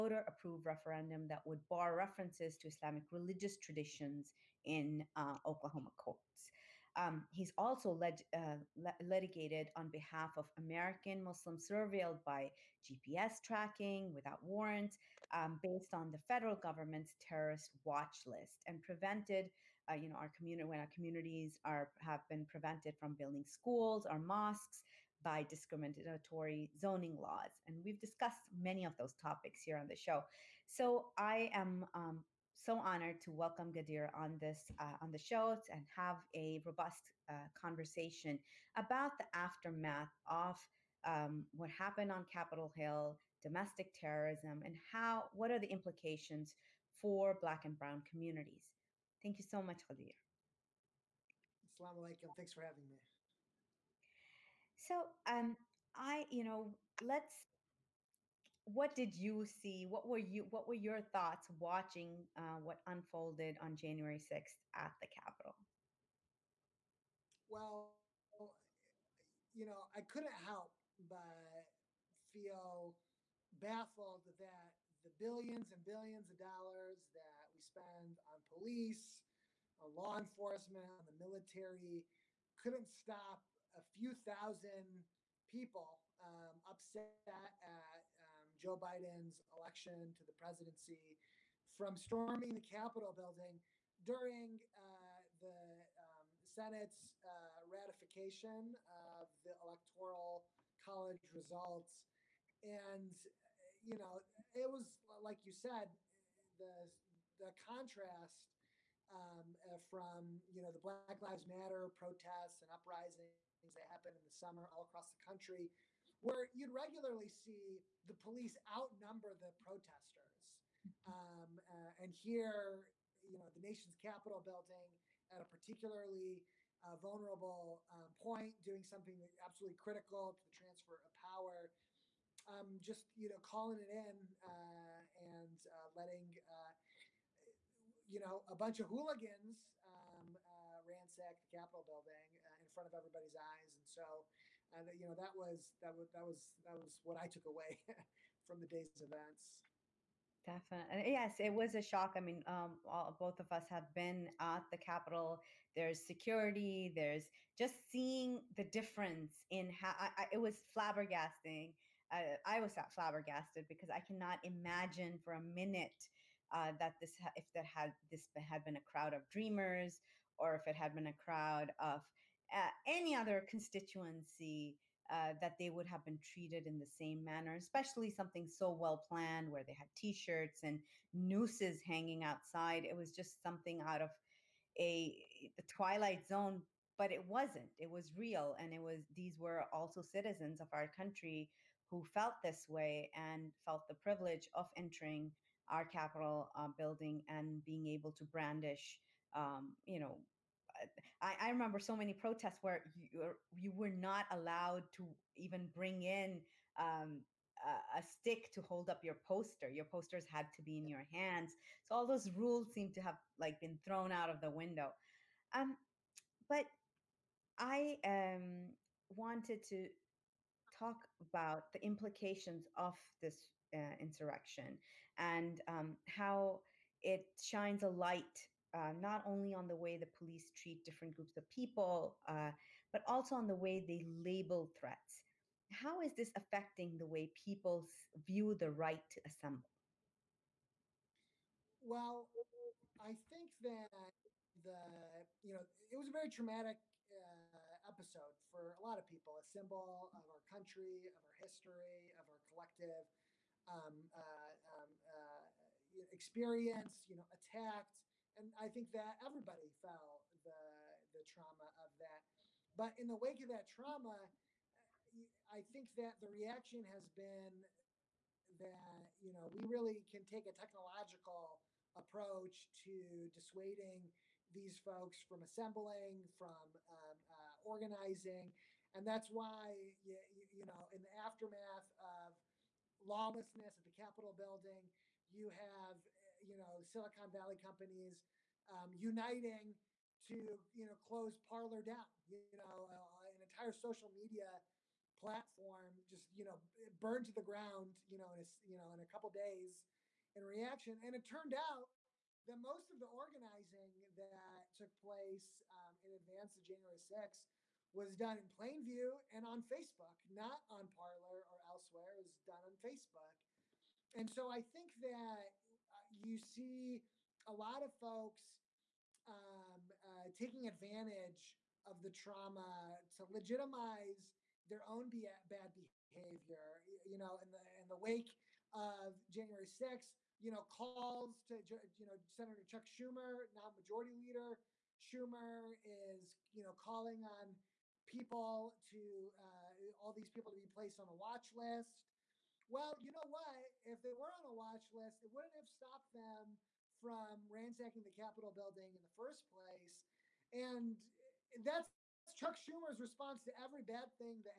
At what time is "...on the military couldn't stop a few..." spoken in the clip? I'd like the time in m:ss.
1:20.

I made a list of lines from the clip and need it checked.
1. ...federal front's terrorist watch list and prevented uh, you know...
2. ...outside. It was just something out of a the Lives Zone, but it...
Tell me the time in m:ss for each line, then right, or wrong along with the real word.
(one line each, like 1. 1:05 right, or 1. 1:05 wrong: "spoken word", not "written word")
1. 0:16 wrong: "government", not "front"
2. 3:02 wrong: "Twilight", not "Lives".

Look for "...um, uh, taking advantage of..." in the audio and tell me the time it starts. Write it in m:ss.
5:19.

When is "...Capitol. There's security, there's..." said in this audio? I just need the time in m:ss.
2:34.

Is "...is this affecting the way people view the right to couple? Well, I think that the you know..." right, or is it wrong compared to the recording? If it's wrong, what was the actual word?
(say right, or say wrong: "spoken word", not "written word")
wrong: "assemble", not "couple".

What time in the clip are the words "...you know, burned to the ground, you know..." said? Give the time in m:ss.
4:56.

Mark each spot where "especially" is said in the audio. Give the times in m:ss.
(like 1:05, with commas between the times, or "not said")
2:57.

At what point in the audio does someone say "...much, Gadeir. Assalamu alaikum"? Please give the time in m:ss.
0:49.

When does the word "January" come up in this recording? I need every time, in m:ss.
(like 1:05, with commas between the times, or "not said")
1:03, 5:06, 5:29.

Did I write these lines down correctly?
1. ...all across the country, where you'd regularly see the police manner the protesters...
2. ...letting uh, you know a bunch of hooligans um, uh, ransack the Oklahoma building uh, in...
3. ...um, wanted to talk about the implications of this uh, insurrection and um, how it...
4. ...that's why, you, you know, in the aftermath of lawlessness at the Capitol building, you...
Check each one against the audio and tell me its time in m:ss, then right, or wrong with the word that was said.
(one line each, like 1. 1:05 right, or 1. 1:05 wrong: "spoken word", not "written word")
1. 1:54 wrong: "outnumber", not "manner"
2. 2:15 wrong: "Capitol", not "Oklahoma"
3. 3:38 right
4. 4:39 right.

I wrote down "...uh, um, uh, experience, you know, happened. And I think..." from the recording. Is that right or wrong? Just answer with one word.
wrong.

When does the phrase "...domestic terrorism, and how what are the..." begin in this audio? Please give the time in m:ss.
0:43.